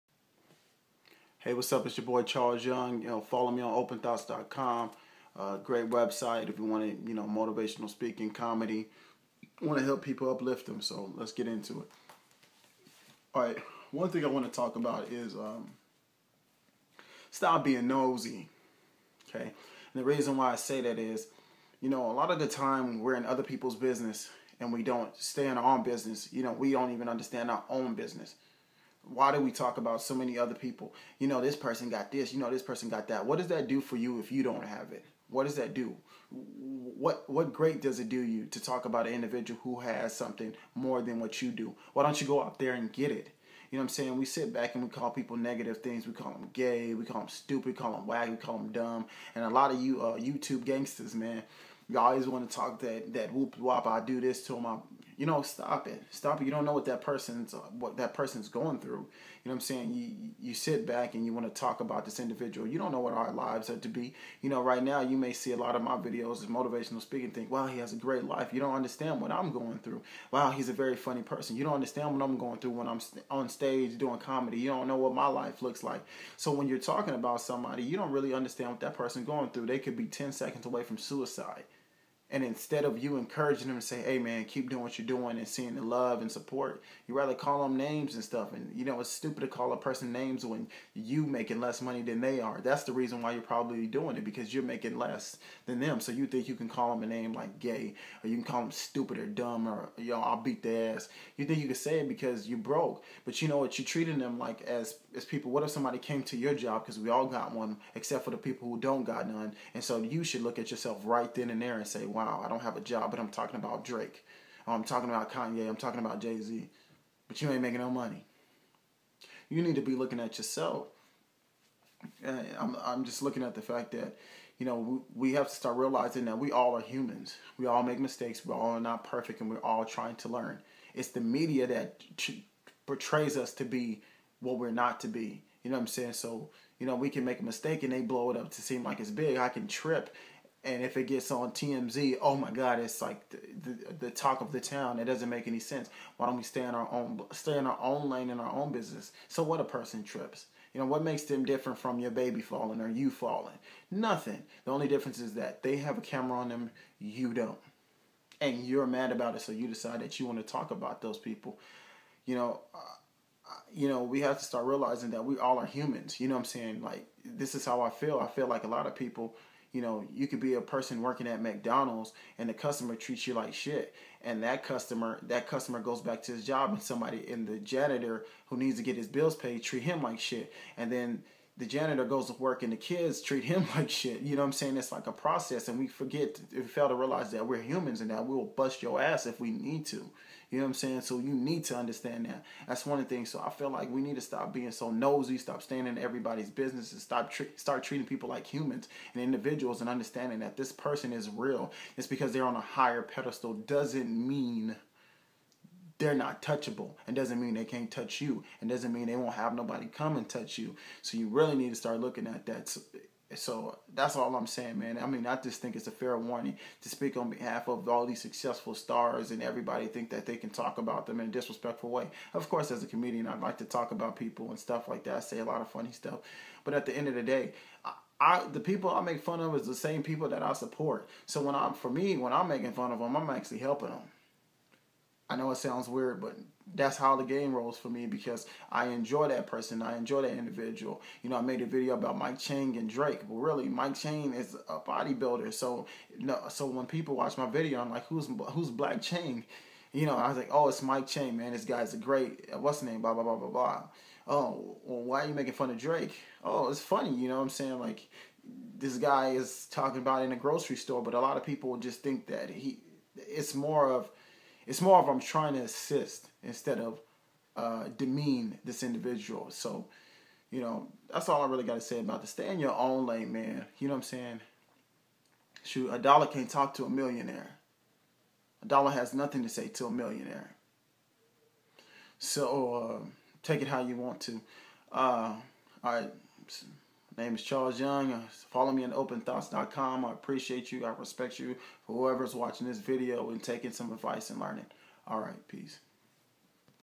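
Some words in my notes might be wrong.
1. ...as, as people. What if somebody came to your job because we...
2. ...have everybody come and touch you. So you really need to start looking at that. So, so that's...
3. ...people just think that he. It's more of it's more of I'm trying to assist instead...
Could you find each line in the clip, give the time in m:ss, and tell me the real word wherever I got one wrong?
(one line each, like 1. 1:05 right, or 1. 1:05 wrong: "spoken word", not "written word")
1. 1:44 right
2. 3:29 wrong: "nobody", not "everybody"
3. 4:21 right.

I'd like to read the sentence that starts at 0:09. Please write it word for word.
Want to help people uplift them.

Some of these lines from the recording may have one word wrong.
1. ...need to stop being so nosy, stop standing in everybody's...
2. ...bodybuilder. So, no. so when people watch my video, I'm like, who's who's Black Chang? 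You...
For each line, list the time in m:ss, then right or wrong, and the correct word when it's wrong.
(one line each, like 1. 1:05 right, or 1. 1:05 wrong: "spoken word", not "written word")
1. 3:14 right
2. 4:04 right.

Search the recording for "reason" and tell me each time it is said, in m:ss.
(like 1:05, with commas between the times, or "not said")
0:20, 1:32.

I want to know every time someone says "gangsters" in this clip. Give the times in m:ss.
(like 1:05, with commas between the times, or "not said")
0:50.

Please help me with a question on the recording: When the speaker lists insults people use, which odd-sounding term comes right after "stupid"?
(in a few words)
wag.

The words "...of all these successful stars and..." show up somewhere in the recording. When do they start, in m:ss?
3:37.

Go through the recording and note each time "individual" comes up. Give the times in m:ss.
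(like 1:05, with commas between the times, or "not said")
0:39, 1:02, 3:19, 4:00, 4:28.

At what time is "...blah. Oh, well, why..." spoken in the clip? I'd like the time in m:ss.
4:13.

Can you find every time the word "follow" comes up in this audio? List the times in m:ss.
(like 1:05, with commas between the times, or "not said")
0:03, 4:48.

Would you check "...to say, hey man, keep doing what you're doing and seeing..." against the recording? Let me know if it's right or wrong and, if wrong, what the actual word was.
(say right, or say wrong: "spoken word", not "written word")
right.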